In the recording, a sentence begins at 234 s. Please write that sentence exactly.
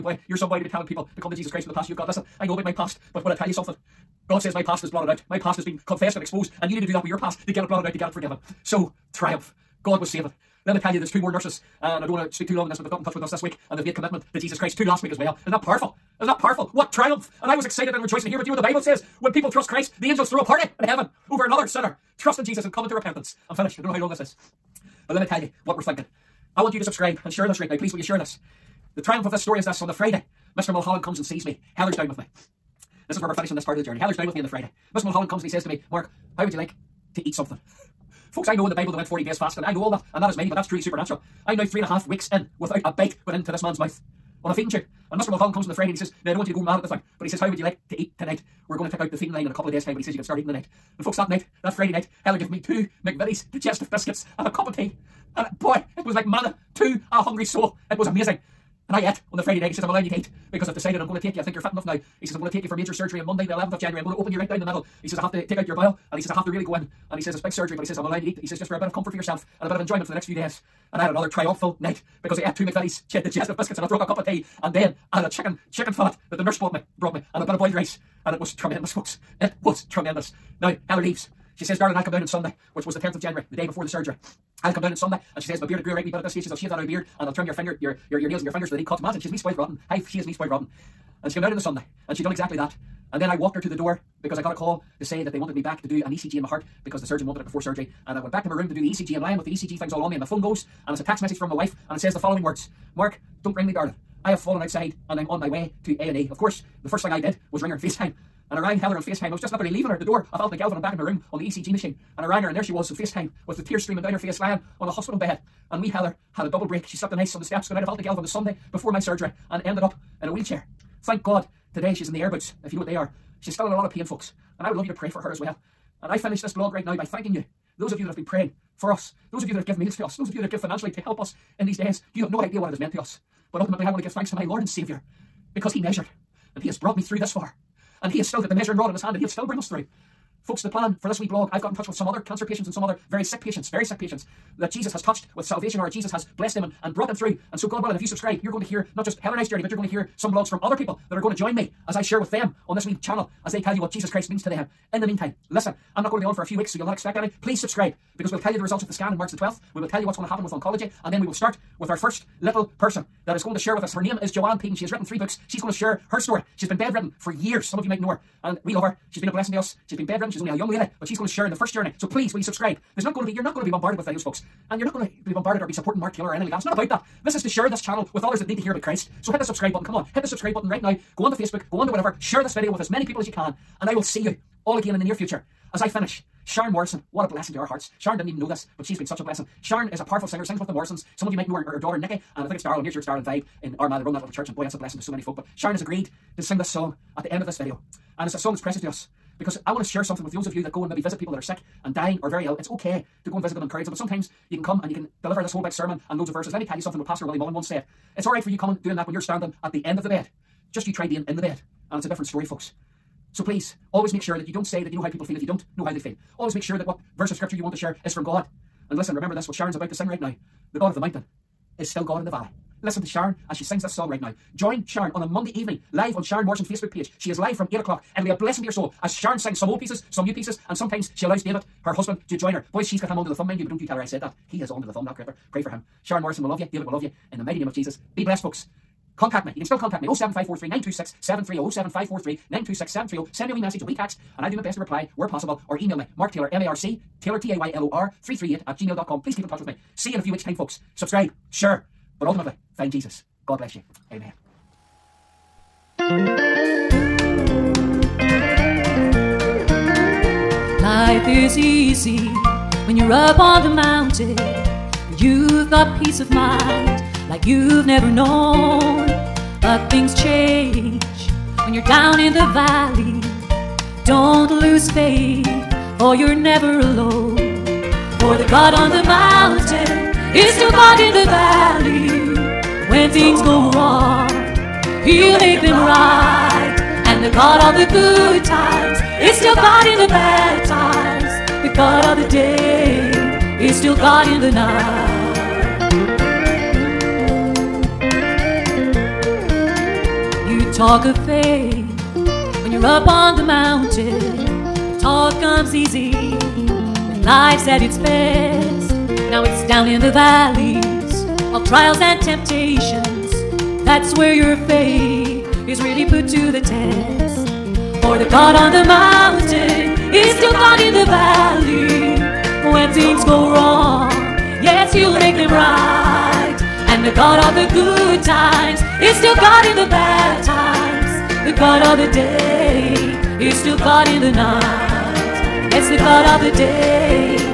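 He is under the thumb, that critter.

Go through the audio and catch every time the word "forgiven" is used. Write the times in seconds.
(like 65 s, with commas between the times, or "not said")
8 s.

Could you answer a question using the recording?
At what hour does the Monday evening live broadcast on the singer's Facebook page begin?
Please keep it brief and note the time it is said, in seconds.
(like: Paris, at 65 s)
8 o'clock, at 227 s.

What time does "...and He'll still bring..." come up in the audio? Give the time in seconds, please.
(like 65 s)
139 s.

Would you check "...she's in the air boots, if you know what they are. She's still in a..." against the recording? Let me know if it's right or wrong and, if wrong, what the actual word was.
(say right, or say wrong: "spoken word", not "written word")
right.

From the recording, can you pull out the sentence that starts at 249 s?
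Please keep in touch with me.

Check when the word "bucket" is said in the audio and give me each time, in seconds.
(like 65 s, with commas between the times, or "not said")
not said.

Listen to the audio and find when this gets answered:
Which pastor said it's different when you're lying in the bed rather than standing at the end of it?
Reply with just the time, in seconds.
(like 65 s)
207 s.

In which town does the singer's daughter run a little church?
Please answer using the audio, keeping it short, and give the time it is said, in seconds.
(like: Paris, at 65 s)
Armagh, at 193 s.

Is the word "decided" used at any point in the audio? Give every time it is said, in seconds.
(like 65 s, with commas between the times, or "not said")
60 s.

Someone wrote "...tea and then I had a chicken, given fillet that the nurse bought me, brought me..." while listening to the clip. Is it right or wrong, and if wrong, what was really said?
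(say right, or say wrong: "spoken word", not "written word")
wrong: "chicken", not "given".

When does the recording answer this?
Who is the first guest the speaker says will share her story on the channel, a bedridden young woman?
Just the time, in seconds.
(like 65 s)
164 s.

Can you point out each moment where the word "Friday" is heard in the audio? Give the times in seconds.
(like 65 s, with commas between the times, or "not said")
29 s, 34 s, 45 s, 51 s, 59 s.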